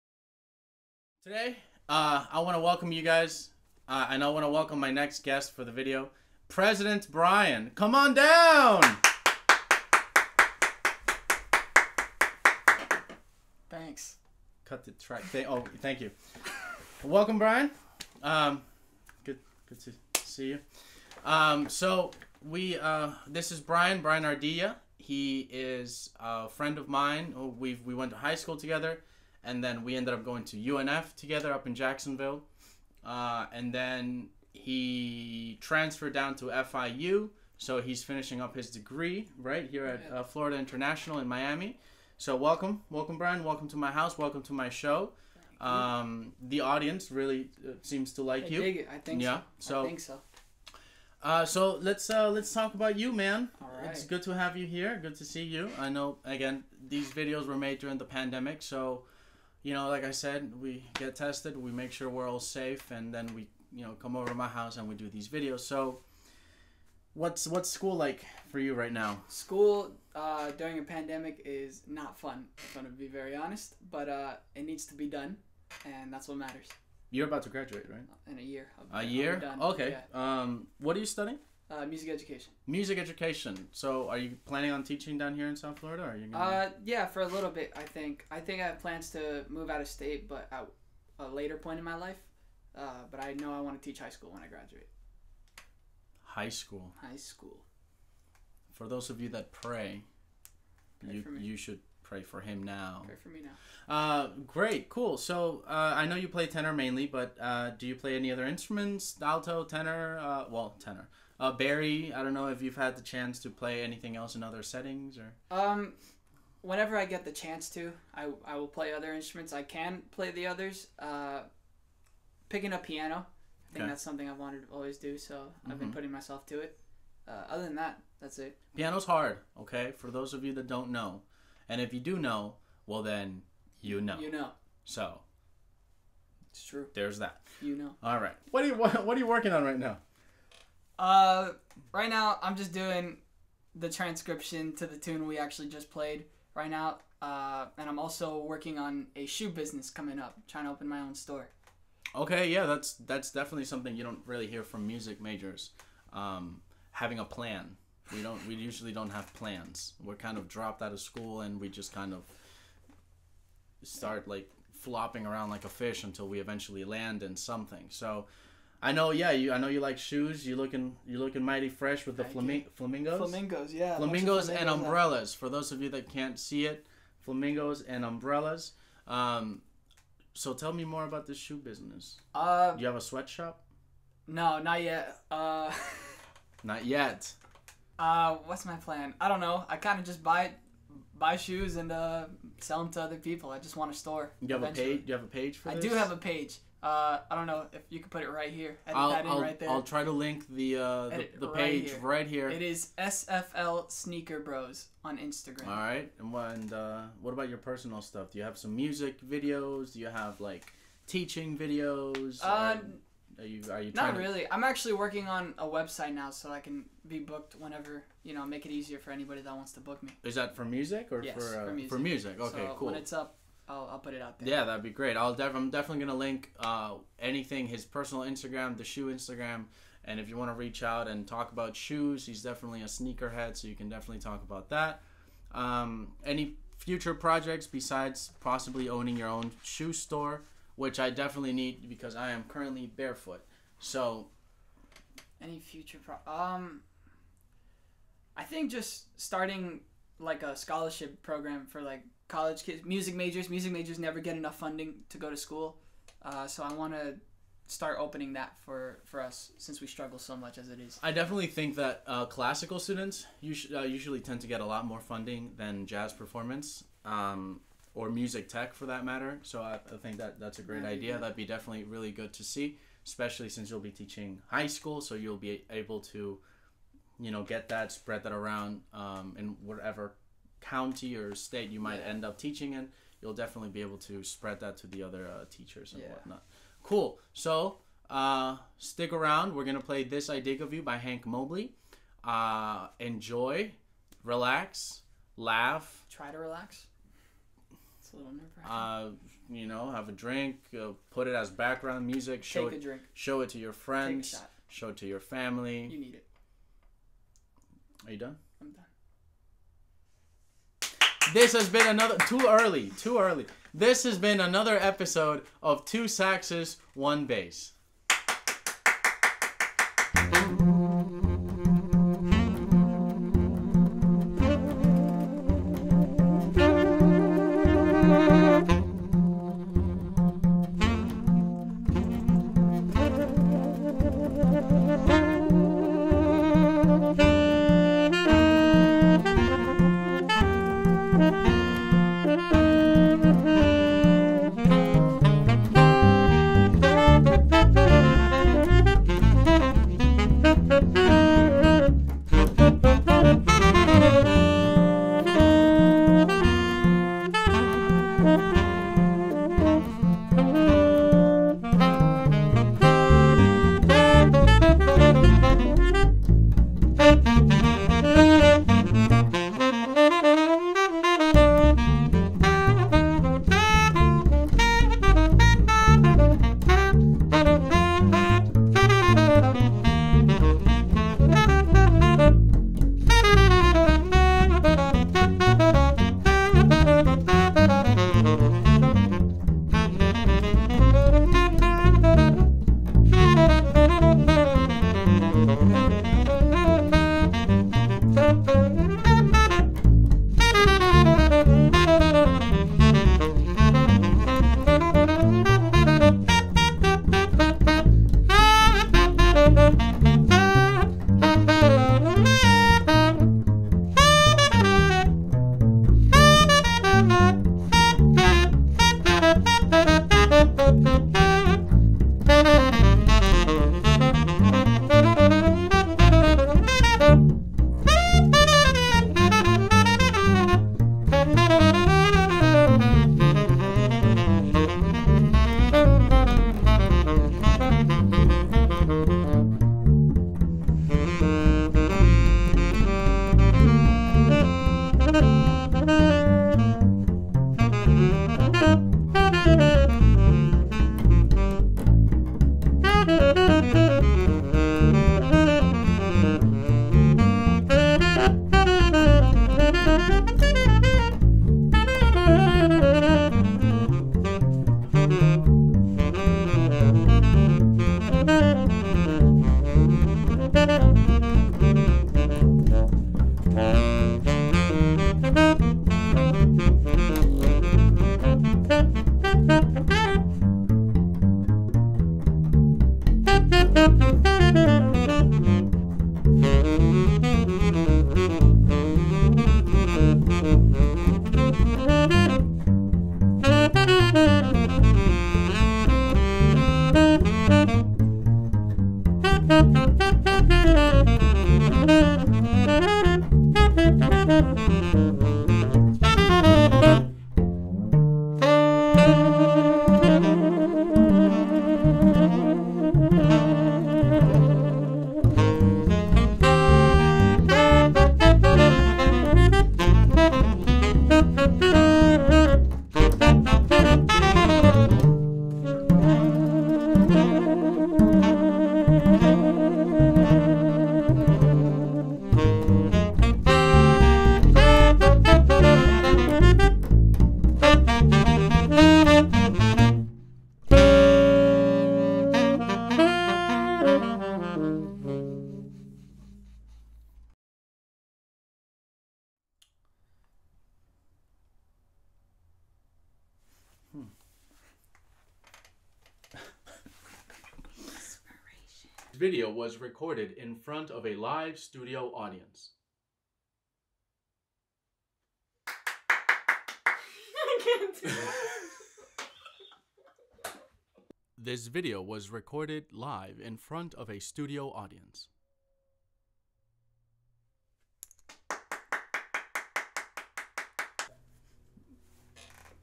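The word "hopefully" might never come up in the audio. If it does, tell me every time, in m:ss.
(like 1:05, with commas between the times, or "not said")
not said.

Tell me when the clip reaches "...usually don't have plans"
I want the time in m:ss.
2:38.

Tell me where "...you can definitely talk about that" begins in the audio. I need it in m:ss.
3:53.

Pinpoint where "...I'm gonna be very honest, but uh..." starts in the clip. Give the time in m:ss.
1:12.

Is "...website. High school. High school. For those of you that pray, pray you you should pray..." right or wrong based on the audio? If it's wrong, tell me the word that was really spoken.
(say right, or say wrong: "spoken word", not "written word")
wrong: "graduate", not "website".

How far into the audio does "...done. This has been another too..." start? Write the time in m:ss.
5:08.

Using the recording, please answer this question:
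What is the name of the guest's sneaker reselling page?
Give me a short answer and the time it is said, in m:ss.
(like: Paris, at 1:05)
SFL Sneaker Bros, at 3:22.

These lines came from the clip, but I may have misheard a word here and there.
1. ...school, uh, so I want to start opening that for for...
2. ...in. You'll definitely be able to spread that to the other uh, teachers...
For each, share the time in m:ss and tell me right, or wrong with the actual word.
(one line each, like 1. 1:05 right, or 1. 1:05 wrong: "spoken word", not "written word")
1. 4:15 right
2. 4:42 right.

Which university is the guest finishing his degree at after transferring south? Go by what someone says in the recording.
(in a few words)
Florida International.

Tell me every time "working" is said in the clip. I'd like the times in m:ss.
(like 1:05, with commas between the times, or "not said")
2:19, 2:28, 3:34.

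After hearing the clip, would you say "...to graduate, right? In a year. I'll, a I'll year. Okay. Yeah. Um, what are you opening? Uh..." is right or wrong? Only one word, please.
wrong.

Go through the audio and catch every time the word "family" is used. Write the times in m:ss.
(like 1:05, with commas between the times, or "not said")
5:05.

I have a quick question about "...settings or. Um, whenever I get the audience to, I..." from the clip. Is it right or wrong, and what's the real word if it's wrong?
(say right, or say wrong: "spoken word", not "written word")
wrong: "chance", not "audience".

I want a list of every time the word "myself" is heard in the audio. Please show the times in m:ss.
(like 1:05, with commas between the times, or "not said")
2:06.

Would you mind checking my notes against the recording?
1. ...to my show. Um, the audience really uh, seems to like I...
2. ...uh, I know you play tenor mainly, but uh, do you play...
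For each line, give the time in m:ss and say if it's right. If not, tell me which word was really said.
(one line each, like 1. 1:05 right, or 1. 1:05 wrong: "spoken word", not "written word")
1. 0:44 right
2. 1:45 right.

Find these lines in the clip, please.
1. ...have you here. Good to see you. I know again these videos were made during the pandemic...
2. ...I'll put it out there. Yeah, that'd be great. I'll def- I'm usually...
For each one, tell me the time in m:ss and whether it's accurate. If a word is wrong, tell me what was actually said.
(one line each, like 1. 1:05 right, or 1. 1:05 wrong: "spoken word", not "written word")
1. 0:54 right
2. 3:43 wrong: "definitely", not "usually".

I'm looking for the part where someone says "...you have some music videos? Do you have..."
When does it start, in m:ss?
3:28.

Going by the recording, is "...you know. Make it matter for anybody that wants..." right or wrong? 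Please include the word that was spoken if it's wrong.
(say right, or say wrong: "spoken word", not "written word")
wrong: "easier", not "matter".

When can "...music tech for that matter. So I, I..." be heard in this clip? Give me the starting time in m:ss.
4:28.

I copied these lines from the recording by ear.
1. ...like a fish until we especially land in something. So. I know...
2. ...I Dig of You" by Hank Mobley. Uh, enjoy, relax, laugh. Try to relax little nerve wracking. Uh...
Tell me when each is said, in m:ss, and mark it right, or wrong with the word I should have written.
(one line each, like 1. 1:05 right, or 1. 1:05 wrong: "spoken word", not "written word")
1. 2:45 wrong: "eventually", not "especially"
2. 4:50 right.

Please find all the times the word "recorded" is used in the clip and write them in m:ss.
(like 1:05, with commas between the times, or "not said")
9:19, 9:32.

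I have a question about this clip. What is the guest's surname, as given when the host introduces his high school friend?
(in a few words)
Ardila.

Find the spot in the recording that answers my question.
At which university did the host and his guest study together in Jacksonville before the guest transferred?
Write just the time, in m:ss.
0:30.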